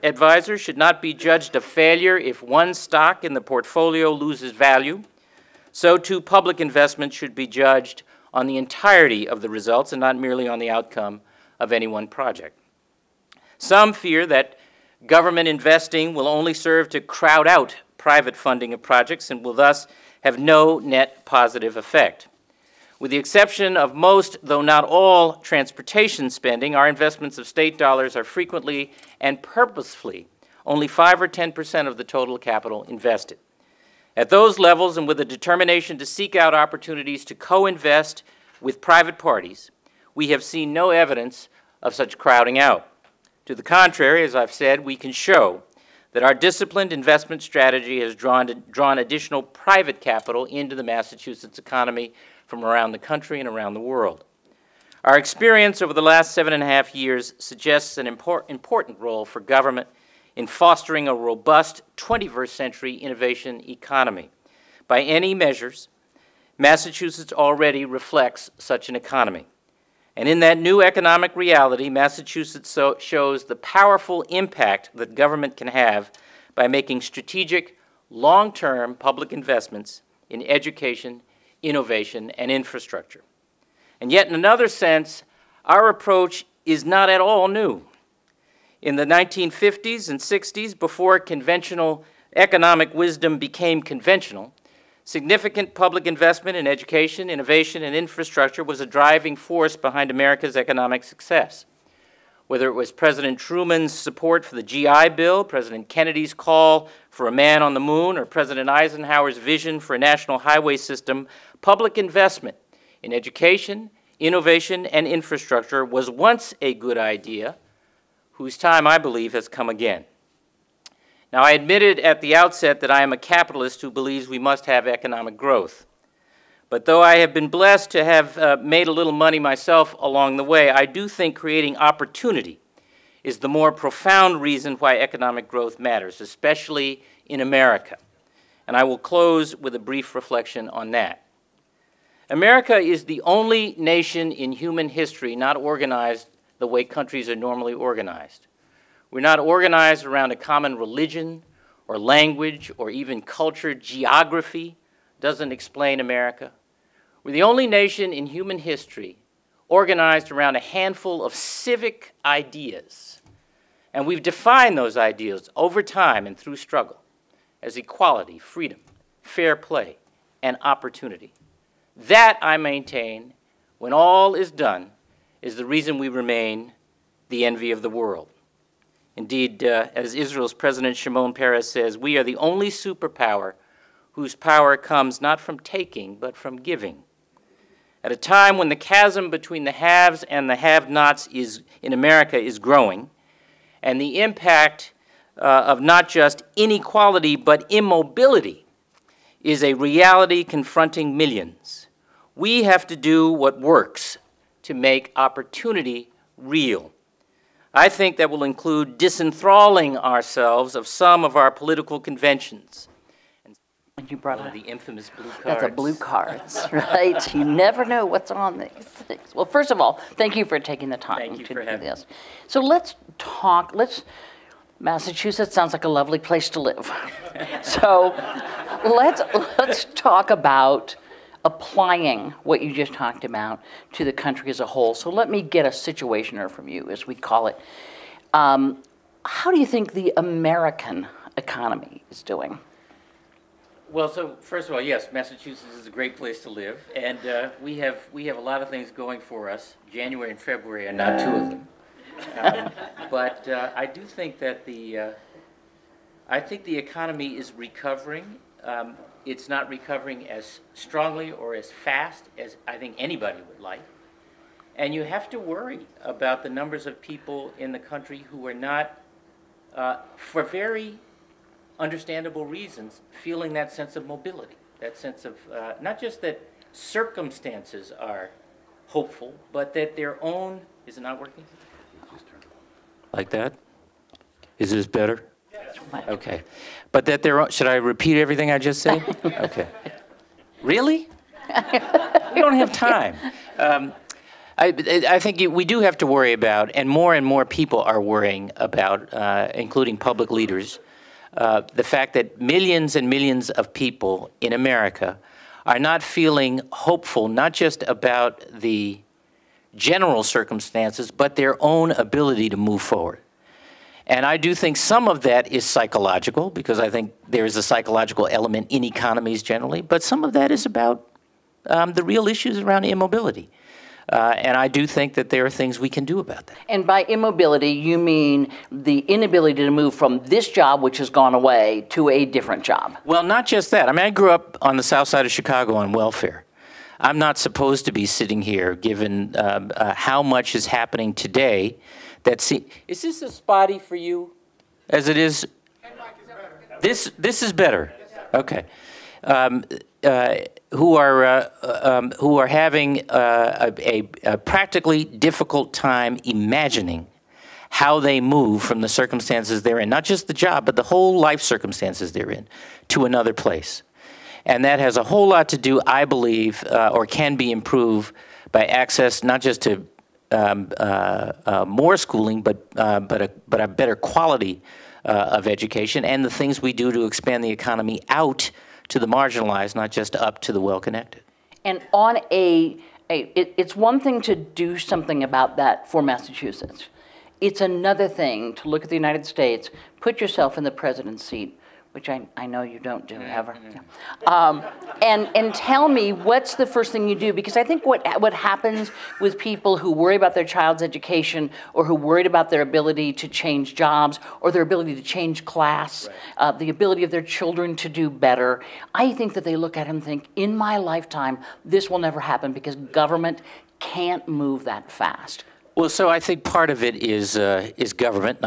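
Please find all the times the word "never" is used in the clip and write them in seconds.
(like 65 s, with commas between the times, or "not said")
217 s, 411 s.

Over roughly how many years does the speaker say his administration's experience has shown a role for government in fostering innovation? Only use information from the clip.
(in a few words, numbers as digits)
7.5 years.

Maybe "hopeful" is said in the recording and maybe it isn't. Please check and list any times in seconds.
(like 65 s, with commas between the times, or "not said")
278 s, 306 s.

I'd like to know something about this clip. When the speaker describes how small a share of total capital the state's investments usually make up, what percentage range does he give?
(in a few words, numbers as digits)
5 or 10 percent.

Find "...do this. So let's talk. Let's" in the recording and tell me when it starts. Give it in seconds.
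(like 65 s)
221 s.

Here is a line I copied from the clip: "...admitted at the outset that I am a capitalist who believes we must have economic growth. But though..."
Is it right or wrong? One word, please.
right.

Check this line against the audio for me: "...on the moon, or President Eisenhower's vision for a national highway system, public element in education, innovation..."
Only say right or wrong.
wrong.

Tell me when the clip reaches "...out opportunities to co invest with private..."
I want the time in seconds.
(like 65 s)
36 s.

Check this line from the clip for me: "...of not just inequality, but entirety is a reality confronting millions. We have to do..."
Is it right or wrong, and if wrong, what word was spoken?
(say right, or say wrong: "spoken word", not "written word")
wrong: "immobility", not "entirety".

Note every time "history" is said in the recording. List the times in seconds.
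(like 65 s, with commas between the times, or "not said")
144 s, 158 s.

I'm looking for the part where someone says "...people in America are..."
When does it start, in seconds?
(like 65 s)
303 s.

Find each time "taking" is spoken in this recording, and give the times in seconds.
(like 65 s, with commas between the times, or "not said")
185 s, 220 s.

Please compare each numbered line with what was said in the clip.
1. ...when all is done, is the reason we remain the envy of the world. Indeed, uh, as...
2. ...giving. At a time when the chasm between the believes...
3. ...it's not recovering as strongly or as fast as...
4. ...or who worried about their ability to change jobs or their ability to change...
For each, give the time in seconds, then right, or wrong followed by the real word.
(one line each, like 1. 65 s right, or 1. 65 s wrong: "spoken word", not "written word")
1. 173 s right
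2. 186 s wrong: "haves", not "believes"
3. 259 s right
4. 401 s right.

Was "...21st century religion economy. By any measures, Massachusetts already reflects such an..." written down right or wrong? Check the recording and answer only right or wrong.
wrong.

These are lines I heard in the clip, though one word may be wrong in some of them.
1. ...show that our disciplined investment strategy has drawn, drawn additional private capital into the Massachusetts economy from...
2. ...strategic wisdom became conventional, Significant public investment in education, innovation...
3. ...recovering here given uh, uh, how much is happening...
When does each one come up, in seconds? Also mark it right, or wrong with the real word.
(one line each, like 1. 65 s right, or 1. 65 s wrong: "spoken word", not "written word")
1. 45 s right
2. 92 s wrong: "economic", not "strategic"
3. 338 s wrong: "sitting", not "recovering".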